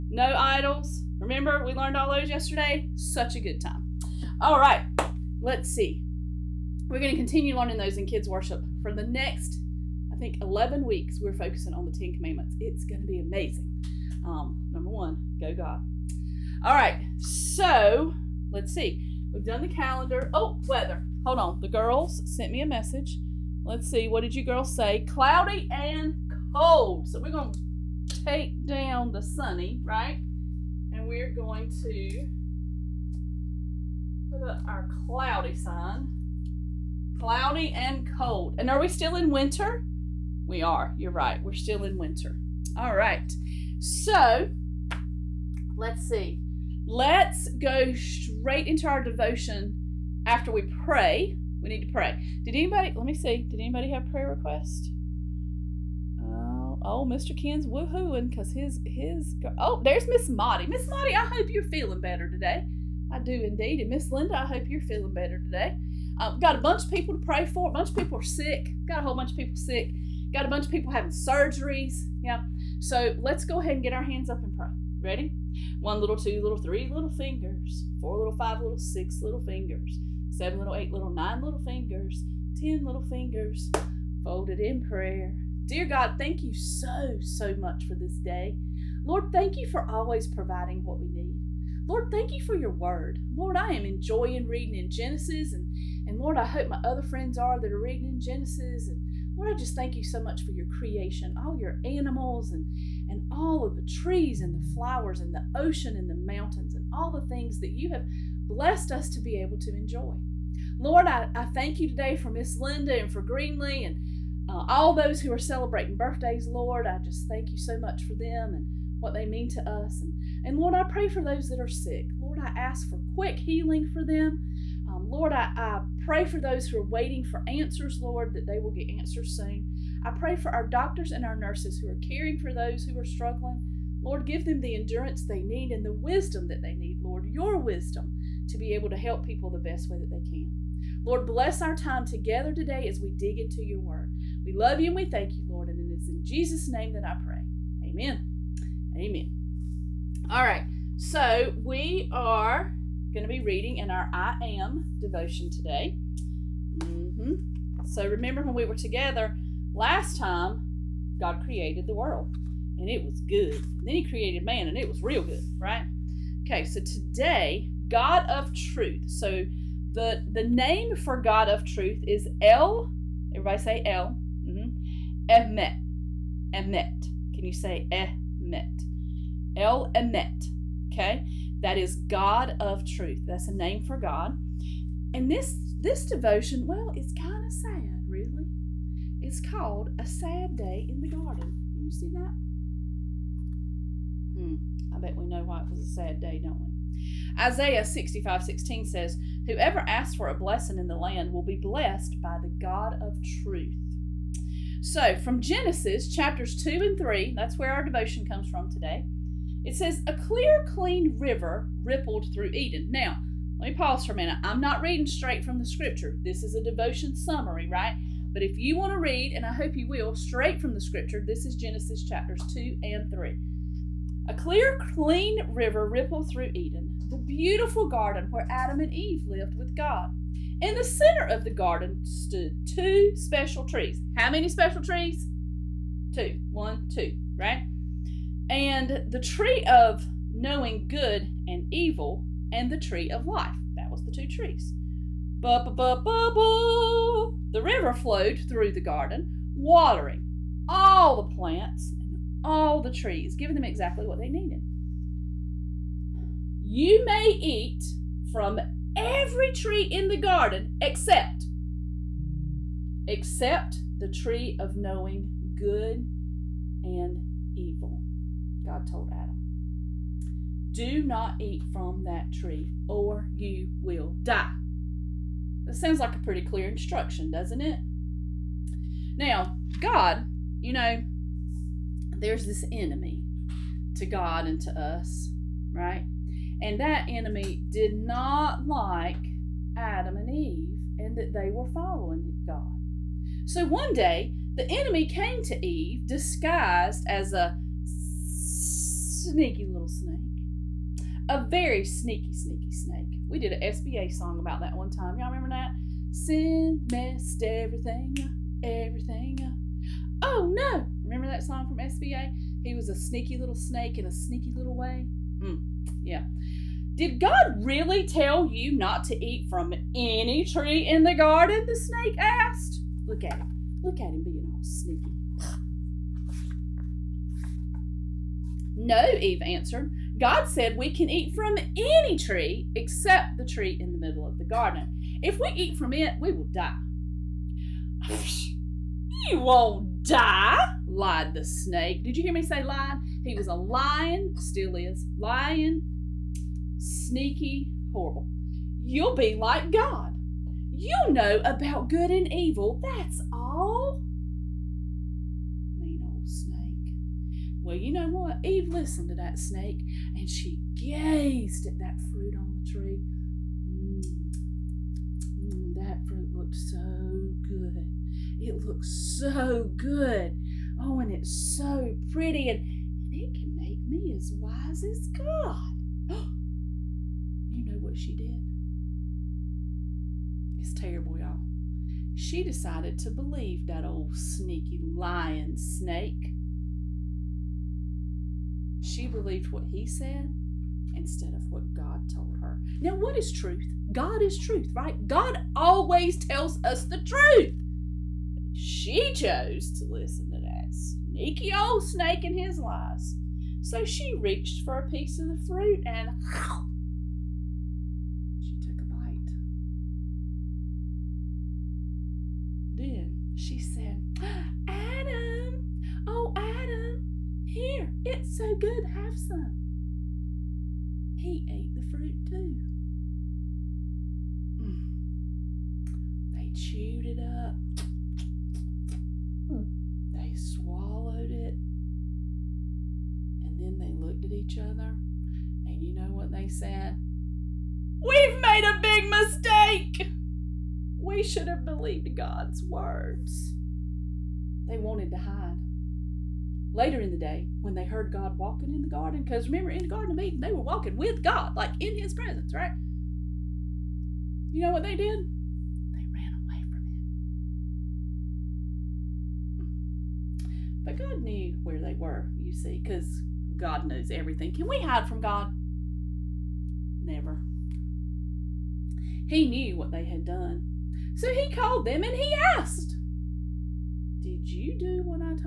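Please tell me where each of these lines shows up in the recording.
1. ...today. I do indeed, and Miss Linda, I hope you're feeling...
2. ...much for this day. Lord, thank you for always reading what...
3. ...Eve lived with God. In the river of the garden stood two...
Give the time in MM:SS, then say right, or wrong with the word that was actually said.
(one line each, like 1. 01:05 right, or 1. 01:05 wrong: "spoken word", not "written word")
1. 01:02 right
2. 01:27 wrong: "providing", not "reading"
3. 03:48 wrong: "center", not "river".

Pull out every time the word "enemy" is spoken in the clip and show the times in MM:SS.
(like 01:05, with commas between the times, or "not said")
04:42, 04:47, 04:54.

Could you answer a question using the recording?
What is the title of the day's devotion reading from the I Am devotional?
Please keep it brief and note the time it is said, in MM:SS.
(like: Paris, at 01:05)
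A Sad Day in the Garden, at 03:09.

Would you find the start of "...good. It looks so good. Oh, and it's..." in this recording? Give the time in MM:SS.
06:07.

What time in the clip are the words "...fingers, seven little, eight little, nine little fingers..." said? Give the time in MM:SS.
01:19.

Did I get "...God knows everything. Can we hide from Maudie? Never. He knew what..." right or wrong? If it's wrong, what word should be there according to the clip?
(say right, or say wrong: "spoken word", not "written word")
wrong: "God", not "Maudie".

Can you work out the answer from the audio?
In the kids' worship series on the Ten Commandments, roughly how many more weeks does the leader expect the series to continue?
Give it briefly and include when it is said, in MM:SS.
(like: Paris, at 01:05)
11, at 00:10.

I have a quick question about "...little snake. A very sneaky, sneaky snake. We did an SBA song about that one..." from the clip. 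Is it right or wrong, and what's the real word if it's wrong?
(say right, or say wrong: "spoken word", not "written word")
right.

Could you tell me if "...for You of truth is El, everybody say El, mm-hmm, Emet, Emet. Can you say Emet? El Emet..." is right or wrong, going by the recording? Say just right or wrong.
wrong.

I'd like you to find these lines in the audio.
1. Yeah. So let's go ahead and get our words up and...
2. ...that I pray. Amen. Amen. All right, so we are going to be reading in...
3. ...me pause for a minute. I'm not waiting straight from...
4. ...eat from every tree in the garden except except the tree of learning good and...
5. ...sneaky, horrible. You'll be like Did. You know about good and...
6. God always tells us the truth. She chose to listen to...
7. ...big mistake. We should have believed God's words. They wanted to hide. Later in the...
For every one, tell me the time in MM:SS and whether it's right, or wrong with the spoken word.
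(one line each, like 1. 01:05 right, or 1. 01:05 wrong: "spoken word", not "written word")
1. 01:12 wrong: "hands", not "words"
2. 02:26 right
3. 03:33 wrong: "reading", not "waiting"
4. 04:17 wrong: "knowing", not "learning"
5. 05:46 wrong: "God", not "Did"
6. 06:35 right
7. 07:18 right.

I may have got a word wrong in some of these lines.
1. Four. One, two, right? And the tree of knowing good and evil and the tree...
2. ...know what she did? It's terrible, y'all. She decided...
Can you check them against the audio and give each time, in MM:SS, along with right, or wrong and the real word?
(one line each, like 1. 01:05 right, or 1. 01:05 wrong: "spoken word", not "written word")
1. 03:56 wrong: "Two", not "Four"
2. 06:17 right.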